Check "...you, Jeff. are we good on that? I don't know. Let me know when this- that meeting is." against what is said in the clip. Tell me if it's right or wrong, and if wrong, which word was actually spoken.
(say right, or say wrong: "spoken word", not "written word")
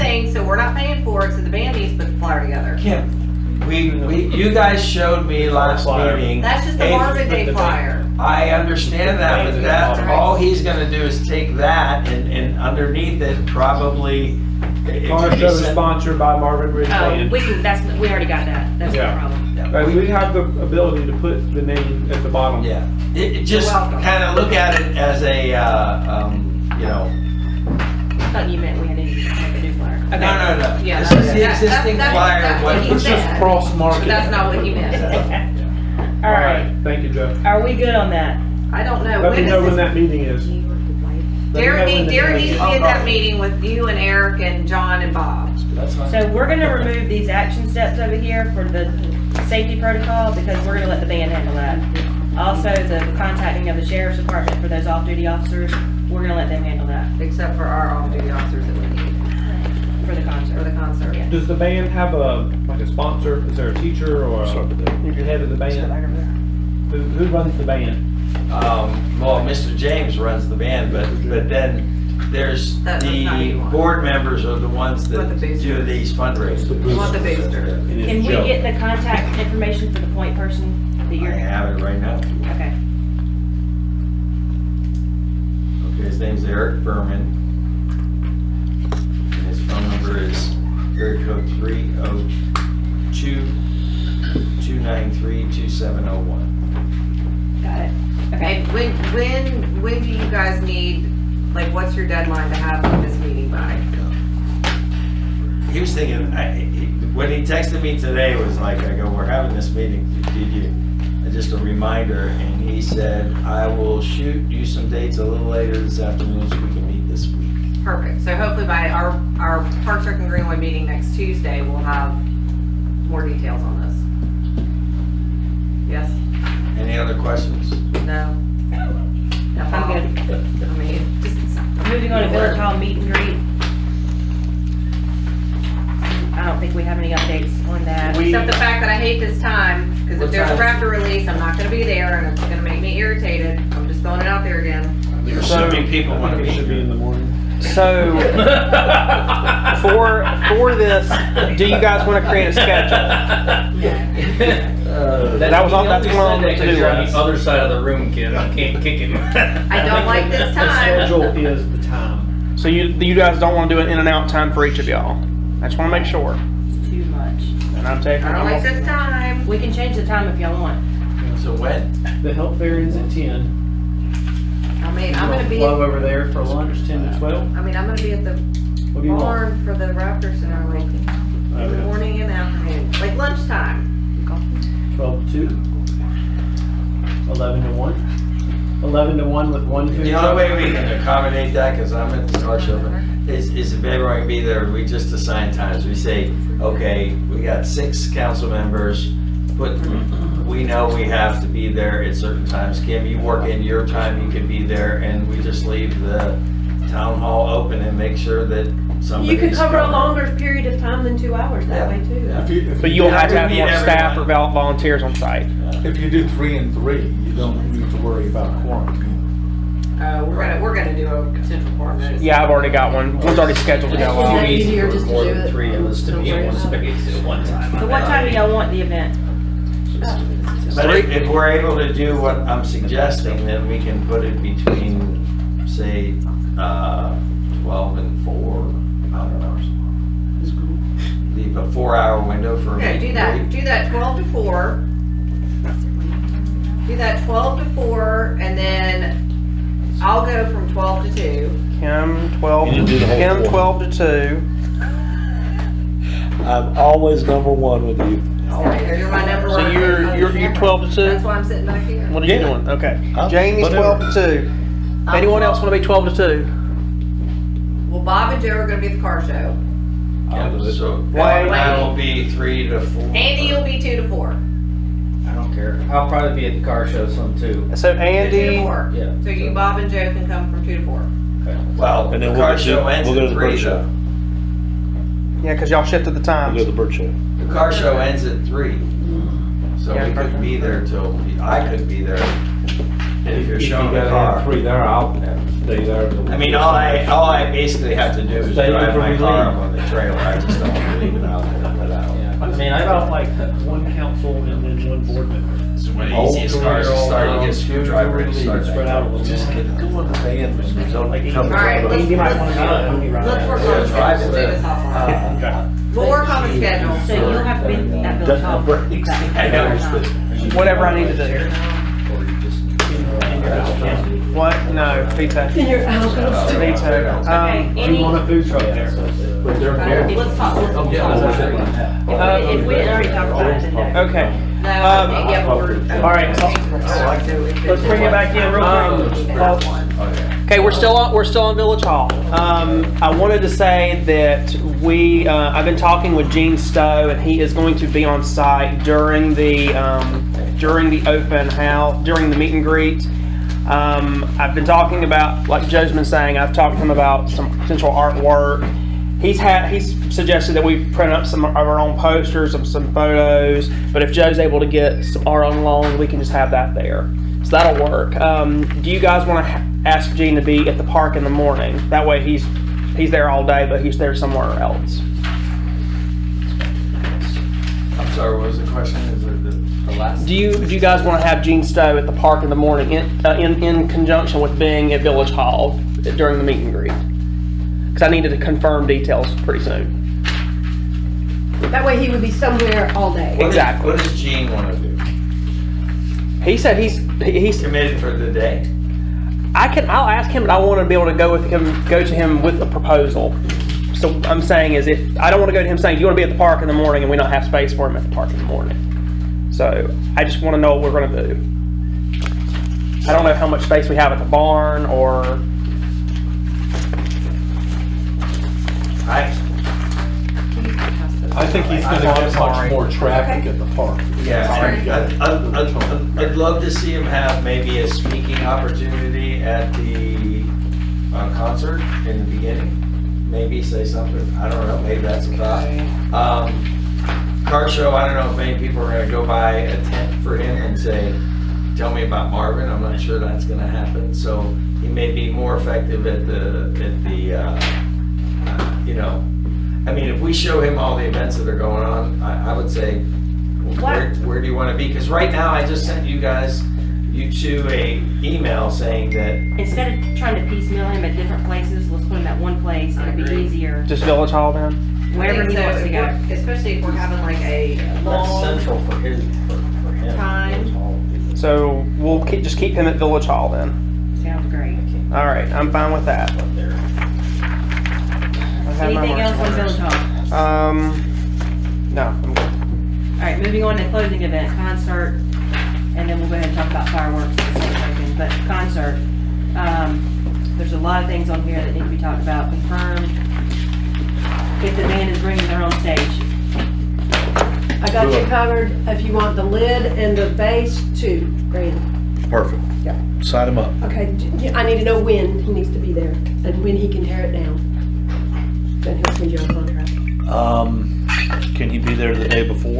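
right.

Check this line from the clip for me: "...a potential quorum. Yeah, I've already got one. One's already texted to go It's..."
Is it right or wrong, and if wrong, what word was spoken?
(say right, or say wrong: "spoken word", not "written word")
wrong: "scheduled", not "texted".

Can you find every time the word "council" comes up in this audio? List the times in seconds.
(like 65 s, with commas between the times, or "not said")
198 s, 303 s.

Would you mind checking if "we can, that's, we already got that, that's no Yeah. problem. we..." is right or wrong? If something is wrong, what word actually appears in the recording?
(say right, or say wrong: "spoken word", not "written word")
right.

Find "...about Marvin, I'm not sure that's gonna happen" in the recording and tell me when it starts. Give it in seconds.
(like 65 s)
442 s.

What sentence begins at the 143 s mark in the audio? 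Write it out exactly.
I'm just throwing it out there again.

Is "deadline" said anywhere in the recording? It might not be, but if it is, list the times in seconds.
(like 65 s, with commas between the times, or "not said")
102 s.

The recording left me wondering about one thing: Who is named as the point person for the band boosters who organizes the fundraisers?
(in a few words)
Eric Berman.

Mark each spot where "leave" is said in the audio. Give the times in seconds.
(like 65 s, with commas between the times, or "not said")
205 s, 241 s, 301 s.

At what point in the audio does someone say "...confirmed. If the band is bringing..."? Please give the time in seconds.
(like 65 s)
492 s.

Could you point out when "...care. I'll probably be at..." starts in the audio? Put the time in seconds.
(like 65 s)
275 s.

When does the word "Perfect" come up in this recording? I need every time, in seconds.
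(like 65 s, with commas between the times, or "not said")
117 s, 502 s.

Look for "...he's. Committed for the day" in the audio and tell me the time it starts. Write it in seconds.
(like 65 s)
397 s.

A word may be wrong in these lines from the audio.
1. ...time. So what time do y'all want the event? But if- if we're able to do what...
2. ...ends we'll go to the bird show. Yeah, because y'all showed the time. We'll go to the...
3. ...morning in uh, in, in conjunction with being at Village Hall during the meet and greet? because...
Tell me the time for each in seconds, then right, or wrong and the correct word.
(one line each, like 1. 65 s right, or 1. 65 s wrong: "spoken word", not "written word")
1. 227 s right
2. 282 s wrong: "shifted", not "showed"
3. 382 s right.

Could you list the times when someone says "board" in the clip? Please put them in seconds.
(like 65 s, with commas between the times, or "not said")
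73 s, 305 s.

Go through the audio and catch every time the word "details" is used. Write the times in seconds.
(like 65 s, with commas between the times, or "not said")
123 s, 388 s.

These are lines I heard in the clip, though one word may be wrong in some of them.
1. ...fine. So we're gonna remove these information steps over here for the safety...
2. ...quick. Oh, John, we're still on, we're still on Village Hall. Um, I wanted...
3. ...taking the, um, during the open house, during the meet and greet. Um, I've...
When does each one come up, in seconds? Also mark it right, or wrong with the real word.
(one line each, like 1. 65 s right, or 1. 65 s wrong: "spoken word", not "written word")
1. 45 s wrong: "action", not "information"
2. 339 s wrong: "Okay", not "John"
3. 348 s wrong: "during", not "taking".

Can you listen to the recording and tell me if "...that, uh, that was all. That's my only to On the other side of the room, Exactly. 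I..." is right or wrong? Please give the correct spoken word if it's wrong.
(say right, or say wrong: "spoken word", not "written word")
wrong: "Kim", not "Exactly".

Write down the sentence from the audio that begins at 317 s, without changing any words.
So you'll have be at the Doesn't have brakes.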